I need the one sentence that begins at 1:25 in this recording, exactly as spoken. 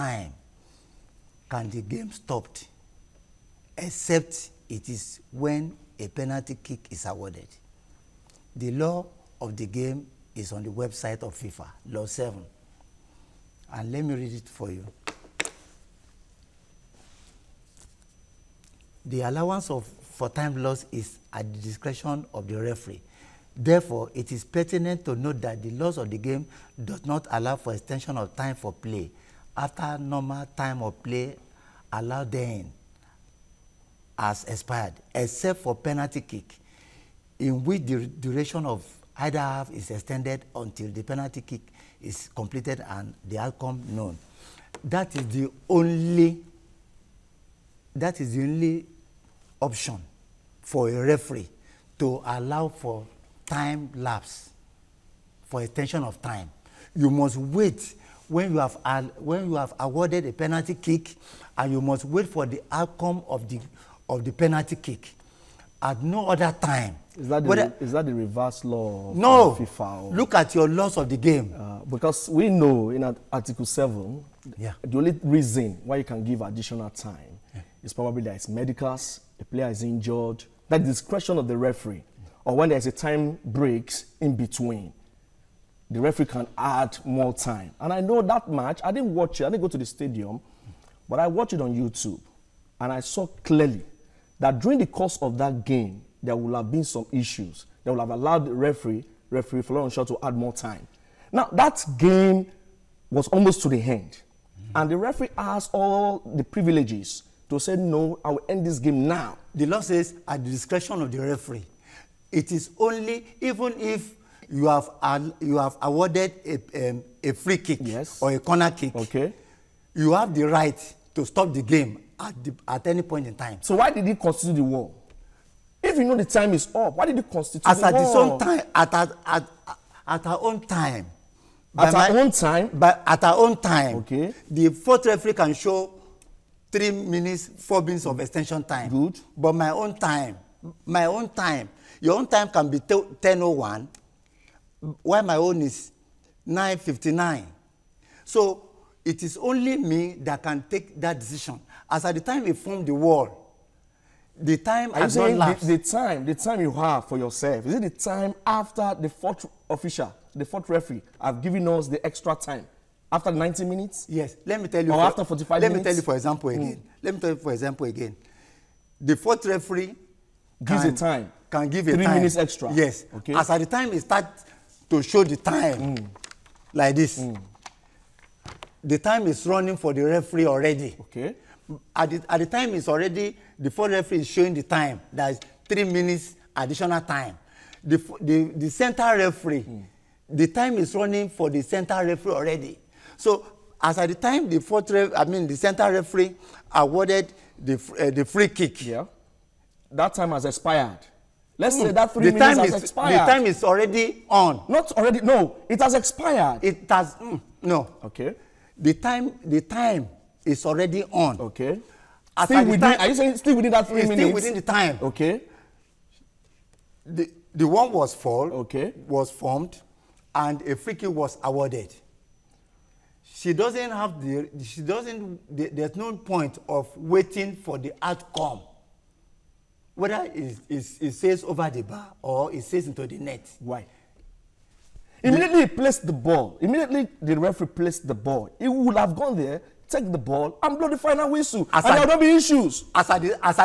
The referee can add more time.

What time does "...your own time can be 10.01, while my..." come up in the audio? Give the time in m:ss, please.
2:22.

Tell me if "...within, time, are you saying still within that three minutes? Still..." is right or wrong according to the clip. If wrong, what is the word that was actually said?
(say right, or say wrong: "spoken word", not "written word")
right.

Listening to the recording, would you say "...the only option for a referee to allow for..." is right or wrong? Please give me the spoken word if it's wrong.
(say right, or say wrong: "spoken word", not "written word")
right.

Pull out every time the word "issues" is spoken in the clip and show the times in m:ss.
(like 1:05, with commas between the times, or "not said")
1:37, 4:02.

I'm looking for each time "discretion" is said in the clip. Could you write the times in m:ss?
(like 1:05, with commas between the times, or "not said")
0:21, 1:20, 1:50.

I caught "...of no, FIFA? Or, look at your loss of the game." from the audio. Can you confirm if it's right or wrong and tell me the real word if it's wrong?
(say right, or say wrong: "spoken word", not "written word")
right.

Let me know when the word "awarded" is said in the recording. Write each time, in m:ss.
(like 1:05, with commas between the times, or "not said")
0:07, 0:59, 1:55, 3:16, 3:41.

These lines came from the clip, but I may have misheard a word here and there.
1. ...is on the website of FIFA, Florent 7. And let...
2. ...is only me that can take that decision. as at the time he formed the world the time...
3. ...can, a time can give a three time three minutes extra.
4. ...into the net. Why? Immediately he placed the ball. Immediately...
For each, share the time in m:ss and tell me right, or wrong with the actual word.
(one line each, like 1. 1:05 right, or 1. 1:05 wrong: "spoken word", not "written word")
1. 0:10 wrong: "Law", not "Florent"
2. 2:29 right
3. 2:50 right
4. 3:52 right.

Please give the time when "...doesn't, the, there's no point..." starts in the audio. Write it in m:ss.
3:44.